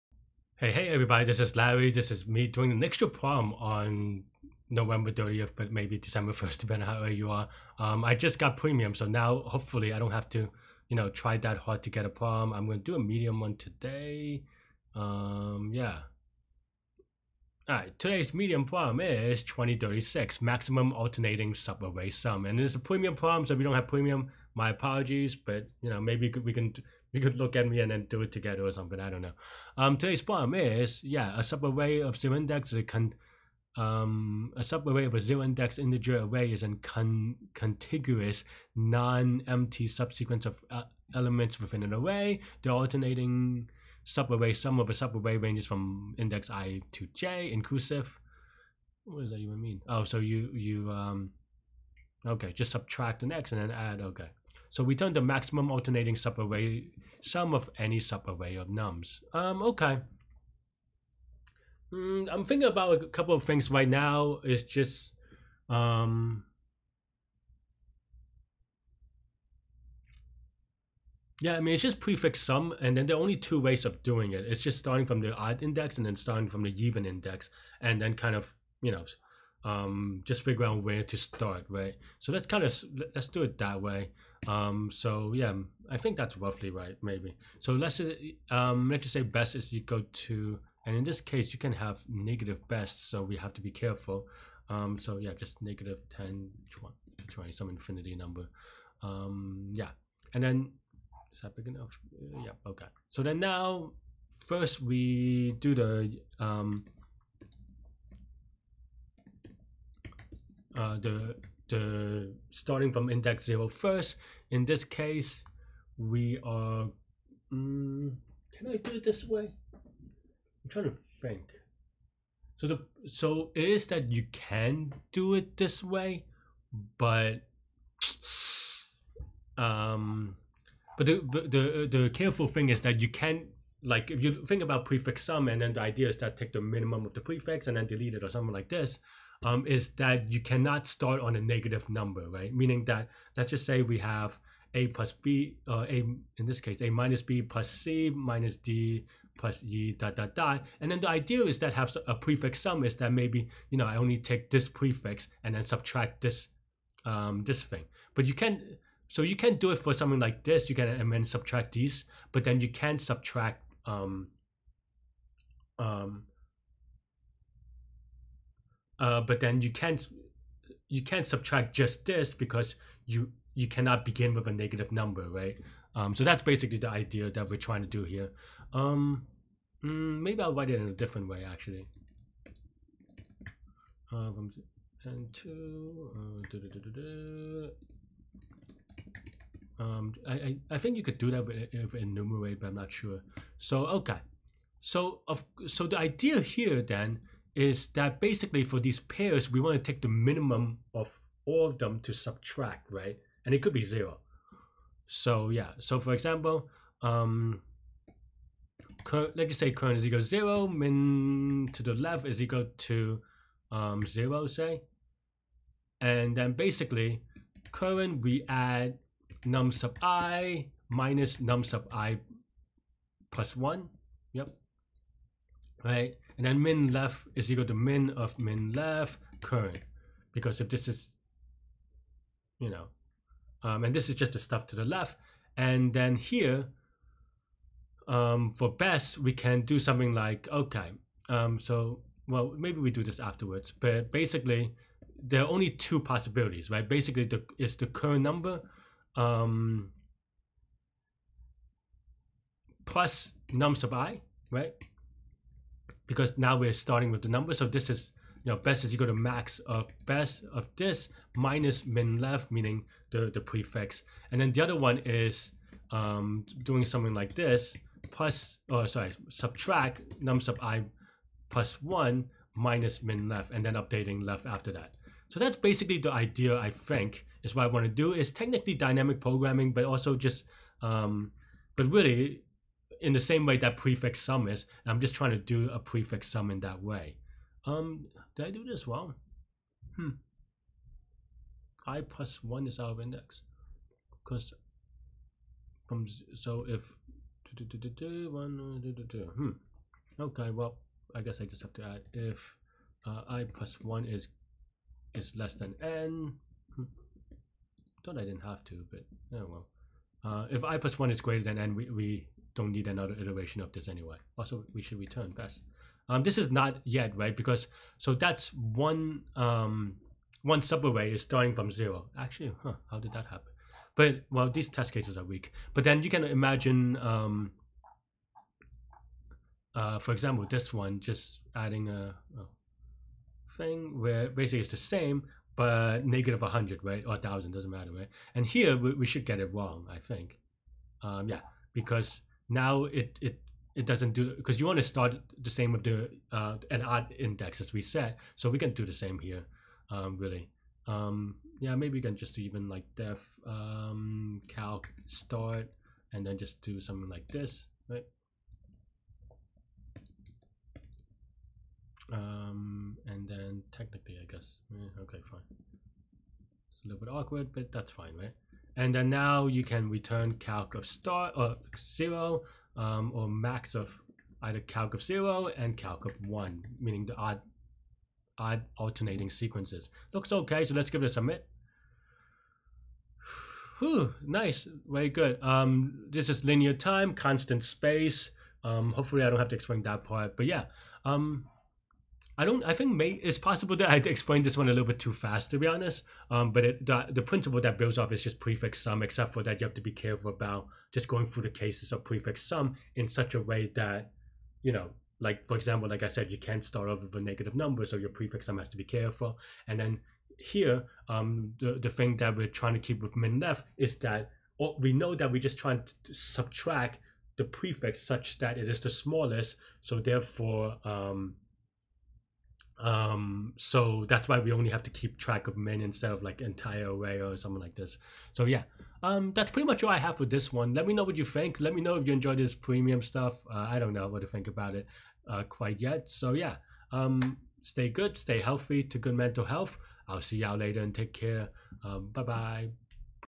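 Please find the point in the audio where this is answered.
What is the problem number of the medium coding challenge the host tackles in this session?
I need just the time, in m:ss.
0:19.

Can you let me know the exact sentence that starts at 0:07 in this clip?
Um, I just got premium, so now hopefully I don't have to, you know, try that hard to get a prom.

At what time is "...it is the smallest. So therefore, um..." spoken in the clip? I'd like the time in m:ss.
6:58.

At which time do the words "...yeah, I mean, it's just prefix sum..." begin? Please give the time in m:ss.
1:11.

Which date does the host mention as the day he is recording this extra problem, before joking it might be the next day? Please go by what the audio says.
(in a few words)
November 30th.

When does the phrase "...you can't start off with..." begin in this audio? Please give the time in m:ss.
6:46.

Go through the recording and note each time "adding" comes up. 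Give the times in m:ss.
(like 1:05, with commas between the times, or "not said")
5:31.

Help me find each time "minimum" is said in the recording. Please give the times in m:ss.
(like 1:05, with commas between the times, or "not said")
2:16, 3:20.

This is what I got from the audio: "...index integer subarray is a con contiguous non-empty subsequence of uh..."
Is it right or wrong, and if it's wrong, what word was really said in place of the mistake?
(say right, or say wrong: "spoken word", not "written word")
wrong: "array", not "subarray".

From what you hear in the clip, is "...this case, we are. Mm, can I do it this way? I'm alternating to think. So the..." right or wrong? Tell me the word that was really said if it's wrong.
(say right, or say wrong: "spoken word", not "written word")
wrong: "trying", not "alternating".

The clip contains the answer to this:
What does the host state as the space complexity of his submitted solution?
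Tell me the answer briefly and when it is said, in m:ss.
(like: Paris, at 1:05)
constant space, at 6:27.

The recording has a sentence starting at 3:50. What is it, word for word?
Because if this is, you know, um, and this is just the stuff to the left.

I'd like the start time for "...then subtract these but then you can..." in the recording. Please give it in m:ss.
2:41.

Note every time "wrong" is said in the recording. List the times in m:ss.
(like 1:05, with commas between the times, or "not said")
4:48, 5:39.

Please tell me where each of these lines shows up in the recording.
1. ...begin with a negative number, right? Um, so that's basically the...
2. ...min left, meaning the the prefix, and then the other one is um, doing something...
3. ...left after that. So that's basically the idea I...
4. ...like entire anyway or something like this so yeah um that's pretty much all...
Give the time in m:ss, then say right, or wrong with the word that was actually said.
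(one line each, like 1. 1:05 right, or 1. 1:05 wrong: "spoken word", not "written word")
1. 2:54 right
2. 4:21 right
3. 4:34 right
4. 7:06 wrong: "array", not "anyway".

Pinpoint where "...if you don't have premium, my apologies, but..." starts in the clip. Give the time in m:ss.
0:23.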